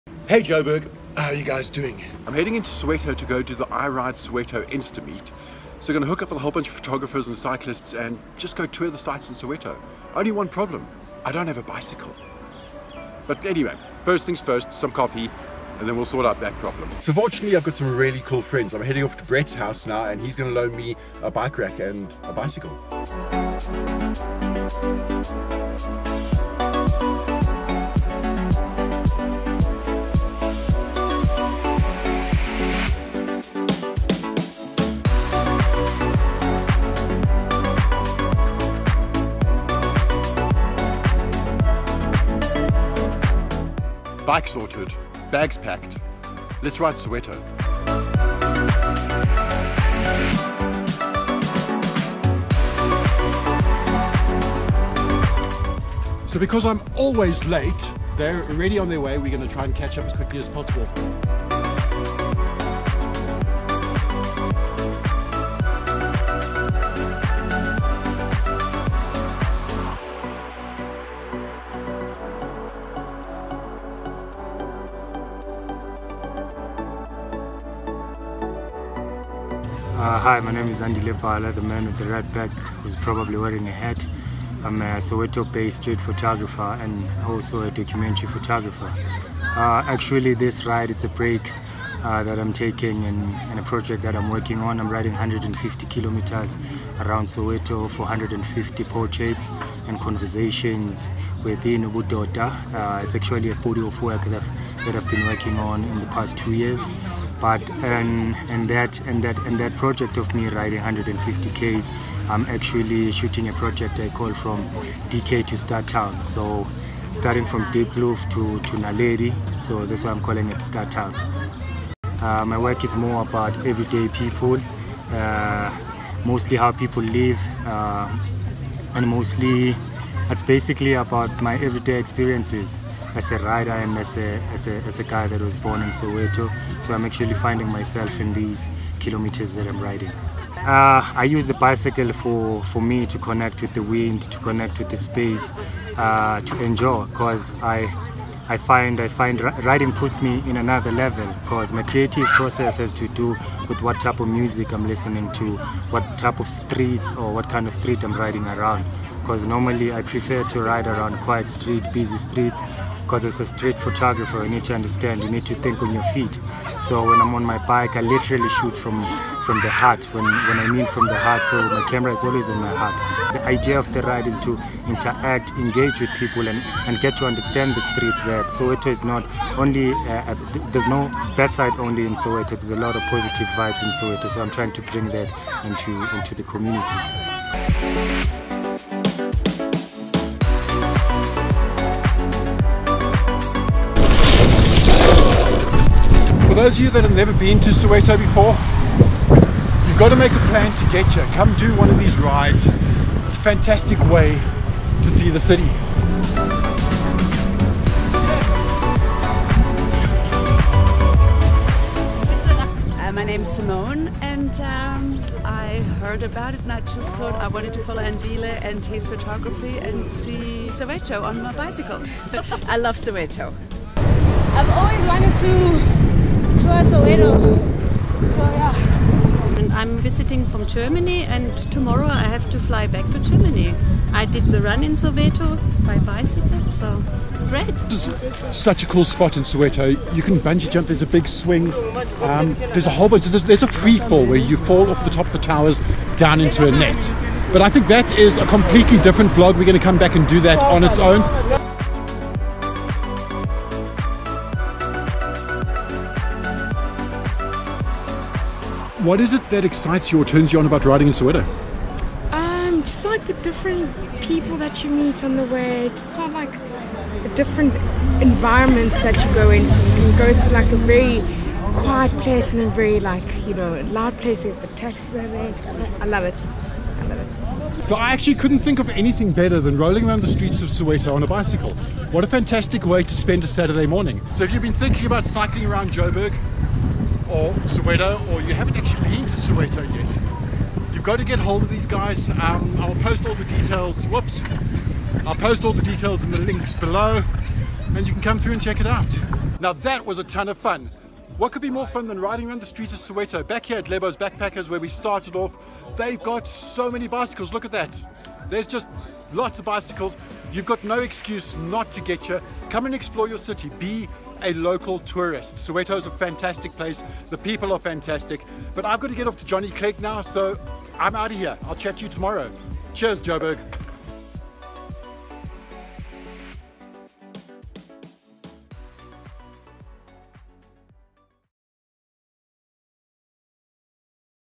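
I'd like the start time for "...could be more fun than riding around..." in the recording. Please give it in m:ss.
5:01.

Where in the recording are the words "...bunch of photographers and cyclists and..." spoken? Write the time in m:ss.
0:06.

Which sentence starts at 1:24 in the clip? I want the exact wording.
I'm a Soweto-based street photographer and also a documentary photographer.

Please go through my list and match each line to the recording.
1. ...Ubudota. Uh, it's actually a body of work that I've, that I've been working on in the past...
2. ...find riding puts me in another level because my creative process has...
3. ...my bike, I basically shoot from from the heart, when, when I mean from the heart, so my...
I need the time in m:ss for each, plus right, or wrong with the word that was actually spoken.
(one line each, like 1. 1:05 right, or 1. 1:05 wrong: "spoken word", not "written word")
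1. 1:41 right
2. 2:29 right
3. 2:47 wrong: "literally", not "basically".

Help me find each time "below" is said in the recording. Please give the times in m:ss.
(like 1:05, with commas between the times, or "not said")
4:56.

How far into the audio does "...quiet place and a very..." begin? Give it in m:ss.
4:31.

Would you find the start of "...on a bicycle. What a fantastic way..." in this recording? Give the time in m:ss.
4:41.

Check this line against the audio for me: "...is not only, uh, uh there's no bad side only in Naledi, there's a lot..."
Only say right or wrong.
wrong.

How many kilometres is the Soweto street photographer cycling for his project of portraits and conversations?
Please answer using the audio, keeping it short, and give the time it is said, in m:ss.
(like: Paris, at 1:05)
150, at 1:35.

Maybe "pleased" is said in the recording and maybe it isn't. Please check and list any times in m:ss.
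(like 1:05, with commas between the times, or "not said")
not said.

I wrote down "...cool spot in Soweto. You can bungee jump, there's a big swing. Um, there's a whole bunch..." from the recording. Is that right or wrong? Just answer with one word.
right.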